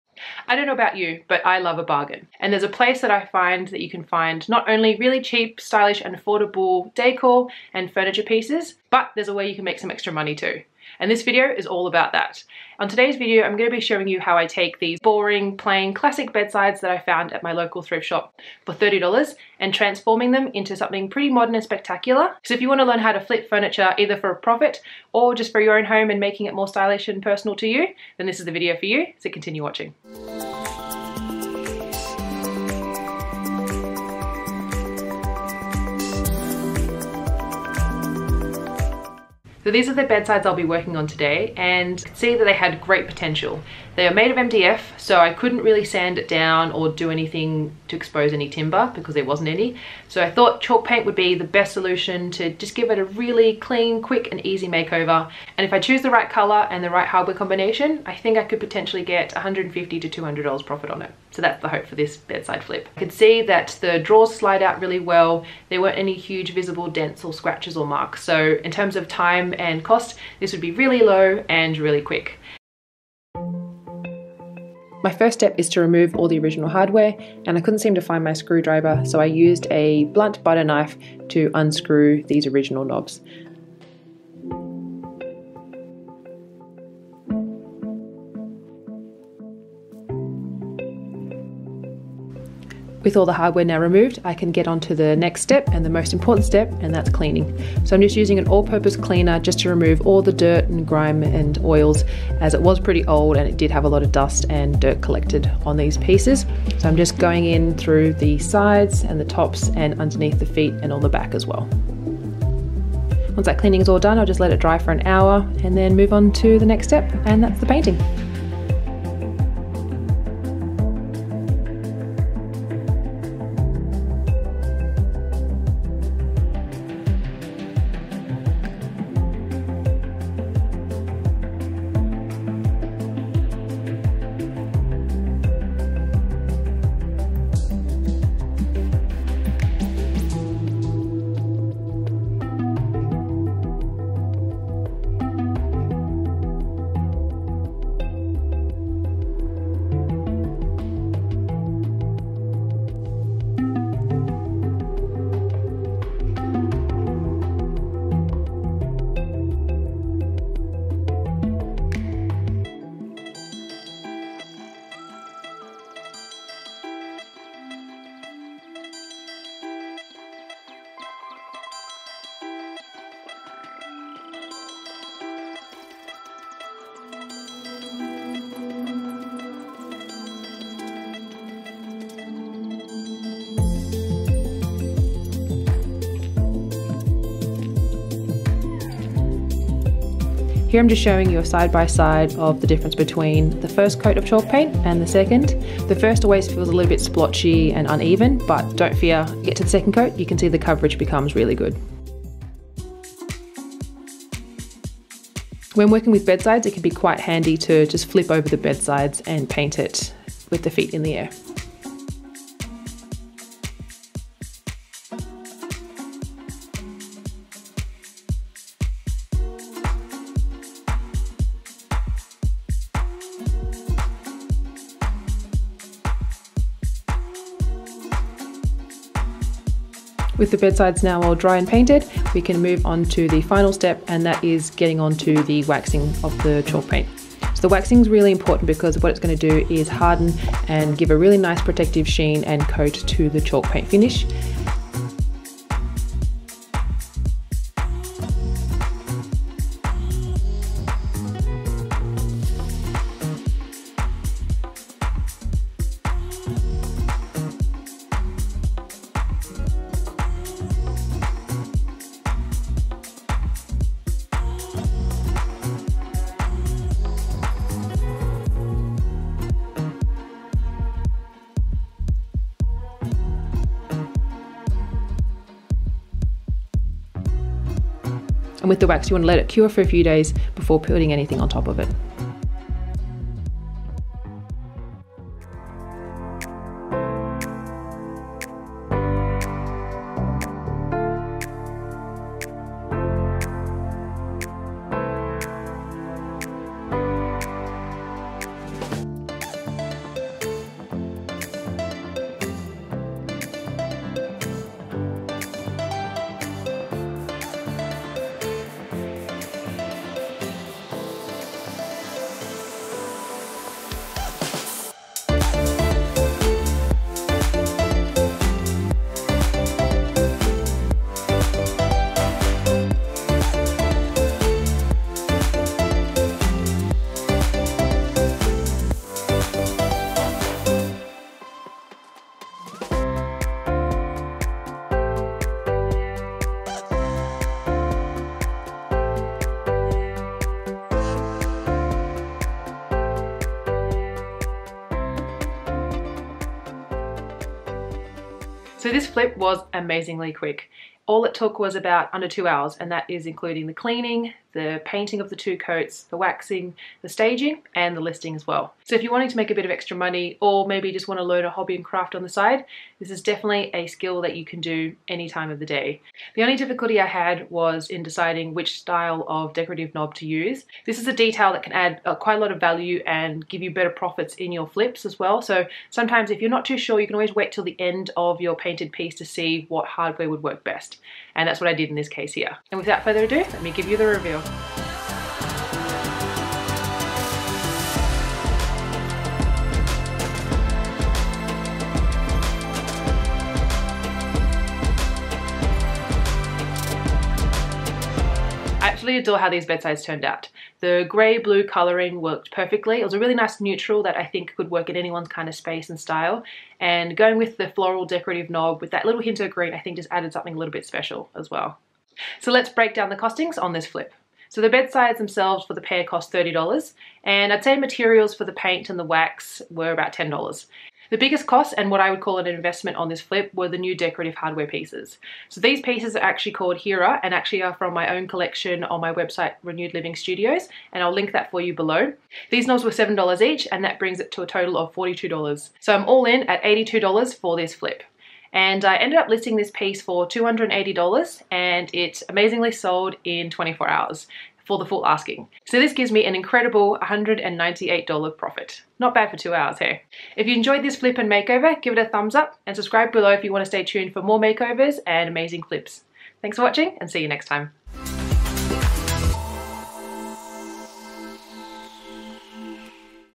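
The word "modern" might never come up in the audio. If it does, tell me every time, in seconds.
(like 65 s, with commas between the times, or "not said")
21 s.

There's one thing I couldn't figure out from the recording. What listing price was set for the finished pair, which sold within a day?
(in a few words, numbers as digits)
$280.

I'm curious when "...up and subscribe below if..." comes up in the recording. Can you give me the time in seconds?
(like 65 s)
452 s.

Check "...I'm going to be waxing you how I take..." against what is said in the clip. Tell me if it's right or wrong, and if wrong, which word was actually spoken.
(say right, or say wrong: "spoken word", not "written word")
wrong: "showing", not "waxing".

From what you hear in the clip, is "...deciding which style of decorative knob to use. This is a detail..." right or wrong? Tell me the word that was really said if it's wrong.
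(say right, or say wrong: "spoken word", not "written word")
right.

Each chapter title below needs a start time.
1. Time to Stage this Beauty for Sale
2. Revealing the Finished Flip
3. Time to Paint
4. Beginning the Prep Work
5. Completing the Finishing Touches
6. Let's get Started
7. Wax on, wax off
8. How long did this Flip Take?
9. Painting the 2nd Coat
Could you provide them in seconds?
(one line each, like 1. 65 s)
1. 314 s
2. 383 s
3. 121 s
4. 74 s
5. 286 s
6. 38 s
7. 203 s
8. 348 s
9. 152 s.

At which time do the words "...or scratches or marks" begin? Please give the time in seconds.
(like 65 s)
67 s.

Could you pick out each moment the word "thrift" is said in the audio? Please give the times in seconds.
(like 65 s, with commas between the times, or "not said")
17 s.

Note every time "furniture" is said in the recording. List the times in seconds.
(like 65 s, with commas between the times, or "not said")
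7 s, 23 s.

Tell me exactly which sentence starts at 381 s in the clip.
And that's what I did in this case here.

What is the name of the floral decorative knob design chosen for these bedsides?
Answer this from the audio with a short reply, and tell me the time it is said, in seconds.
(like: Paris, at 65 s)
Hera, at 426 s.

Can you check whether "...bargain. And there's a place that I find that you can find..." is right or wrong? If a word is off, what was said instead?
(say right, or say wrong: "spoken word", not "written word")
right.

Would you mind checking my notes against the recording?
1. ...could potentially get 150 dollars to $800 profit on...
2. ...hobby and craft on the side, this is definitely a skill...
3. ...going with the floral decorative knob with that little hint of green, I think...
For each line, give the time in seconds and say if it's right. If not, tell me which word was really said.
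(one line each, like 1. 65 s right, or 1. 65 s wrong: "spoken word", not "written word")
1. 58 s wrong: "200", not "800"
2. 361 s right
3. 407 s right.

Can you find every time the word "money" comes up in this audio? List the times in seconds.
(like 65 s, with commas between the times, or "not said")
10 s, 359 s.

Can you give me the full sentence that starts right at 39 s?
So these are the bedsides I'll be working on today and see that they had great potential.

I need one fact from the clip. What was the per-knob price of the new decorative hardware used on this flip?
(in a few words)
$7.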